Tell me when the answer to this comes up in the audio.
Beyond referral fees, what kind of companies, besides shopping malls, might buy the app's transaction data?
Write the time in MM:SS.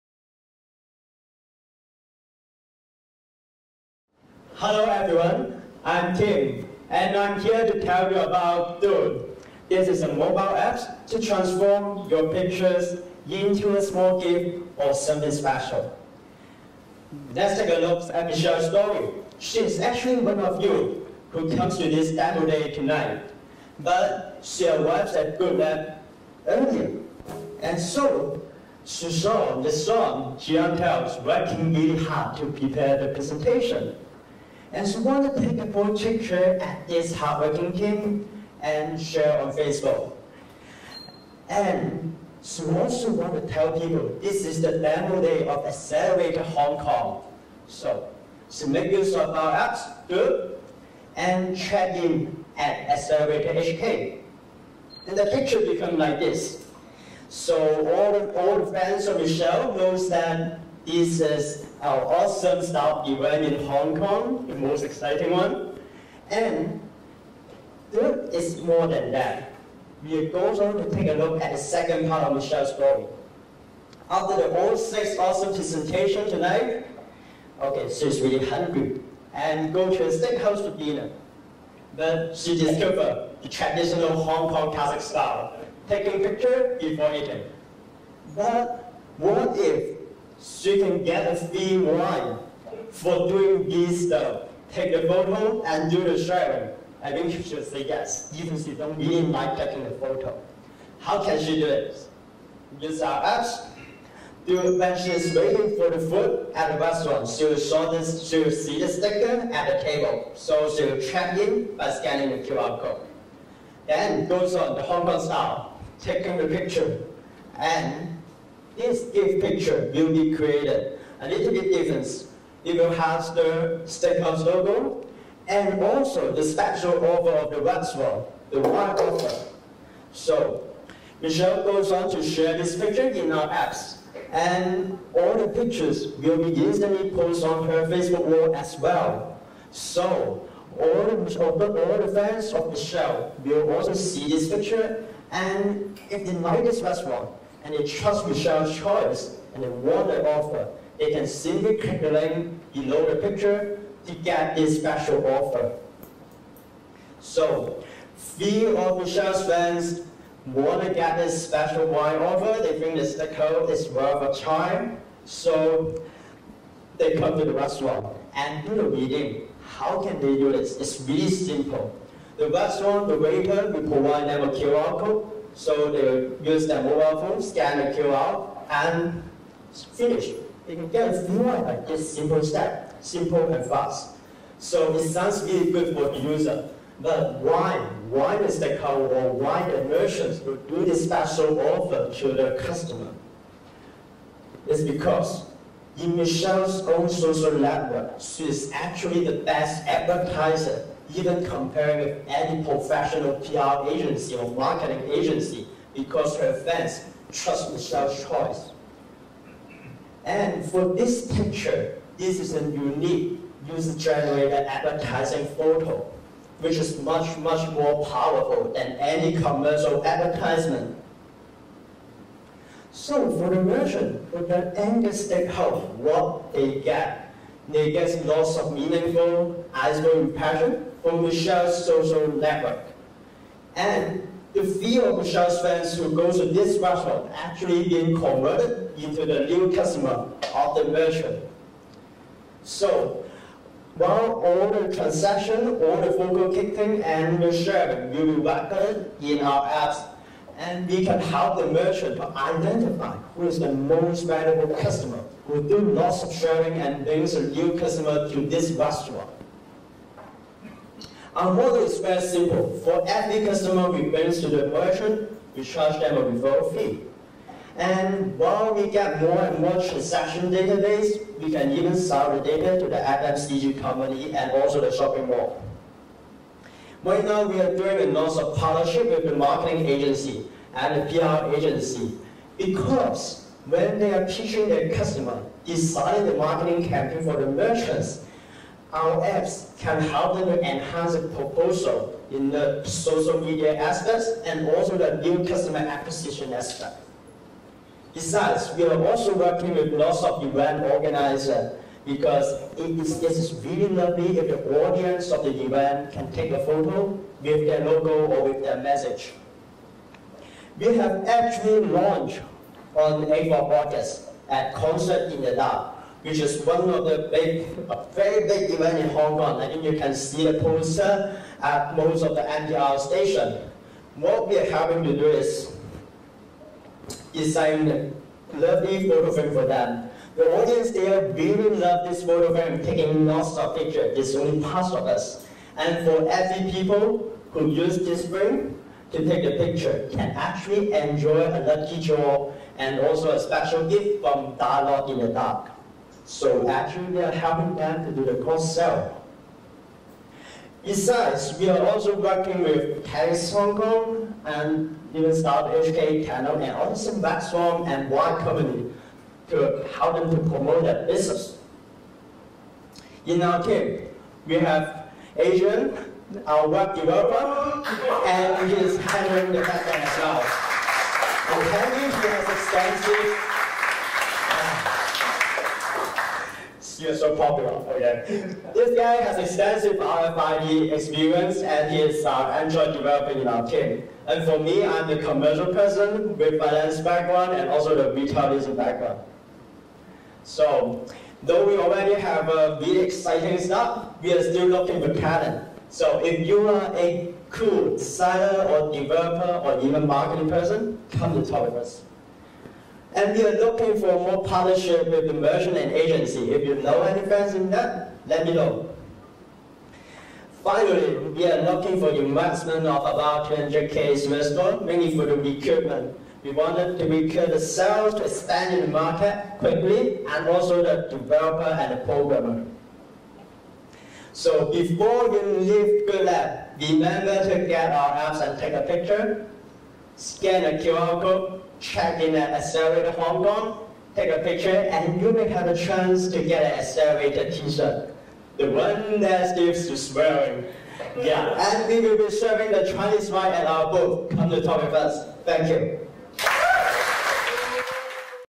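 04:32.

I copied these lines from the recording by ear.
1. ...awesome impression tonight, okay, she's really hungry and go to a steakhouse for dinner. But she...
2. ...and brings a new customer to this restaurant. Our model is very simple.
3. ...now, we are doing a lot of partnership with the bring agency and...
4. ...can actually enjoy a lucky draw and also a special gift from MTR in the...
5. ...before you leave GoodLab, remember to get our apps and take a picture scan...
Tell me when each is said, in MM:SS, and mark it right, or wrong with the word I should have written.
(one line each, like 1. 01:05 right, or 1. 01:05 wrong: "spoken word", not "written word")
1. 01:15 wrong: "presentation", not "impression"
2. 04:16 right
3. 04:37 wrong: "marketing", not "bring"
4. 05:40 wrong: "Dialogue", not "MTR"
5. 07:04 right.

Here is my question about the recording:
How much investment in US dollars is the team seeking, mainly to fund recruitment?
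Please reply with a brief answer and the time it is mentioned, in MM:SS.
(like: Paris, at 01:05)
200k US dollars, at 06:53.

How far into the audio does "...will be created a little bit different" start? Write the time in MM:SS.
01:59.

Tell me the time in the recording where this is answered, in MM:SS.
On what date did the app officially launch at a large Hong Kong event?
05:13.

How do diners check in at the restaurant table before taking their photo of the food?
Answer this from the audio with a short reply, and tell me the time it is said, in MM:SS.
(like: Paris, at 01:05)
scanning the QR code, at 01:51.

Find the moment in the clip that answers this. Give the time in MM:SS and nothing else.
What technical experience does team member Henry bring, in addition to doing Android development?
06:19.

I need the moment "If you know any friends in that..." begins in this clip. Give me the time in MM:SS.
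06:46.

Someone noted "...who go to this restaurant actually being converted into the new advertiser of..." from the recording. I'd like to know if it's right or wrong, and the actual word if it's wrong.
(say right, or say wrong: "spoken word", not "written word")
wrong: "customer", not "advertiser".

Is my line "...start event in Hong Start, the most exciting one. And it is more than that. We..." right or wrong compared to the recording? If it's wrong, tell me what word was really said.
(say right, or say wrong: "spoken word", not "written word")
wrong: "Kong", not "Start".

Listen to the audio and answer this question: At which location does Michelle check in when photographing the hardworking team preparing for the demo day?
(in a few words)
Accelerator HK.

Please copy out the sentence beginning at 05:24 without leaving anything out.
What we are having to do is design a lovely photo frame for them.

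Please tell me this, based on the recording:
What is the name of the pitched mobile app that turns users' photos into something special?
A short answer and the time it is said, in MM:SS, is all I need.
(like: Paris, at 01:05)
Dood, at 00:08.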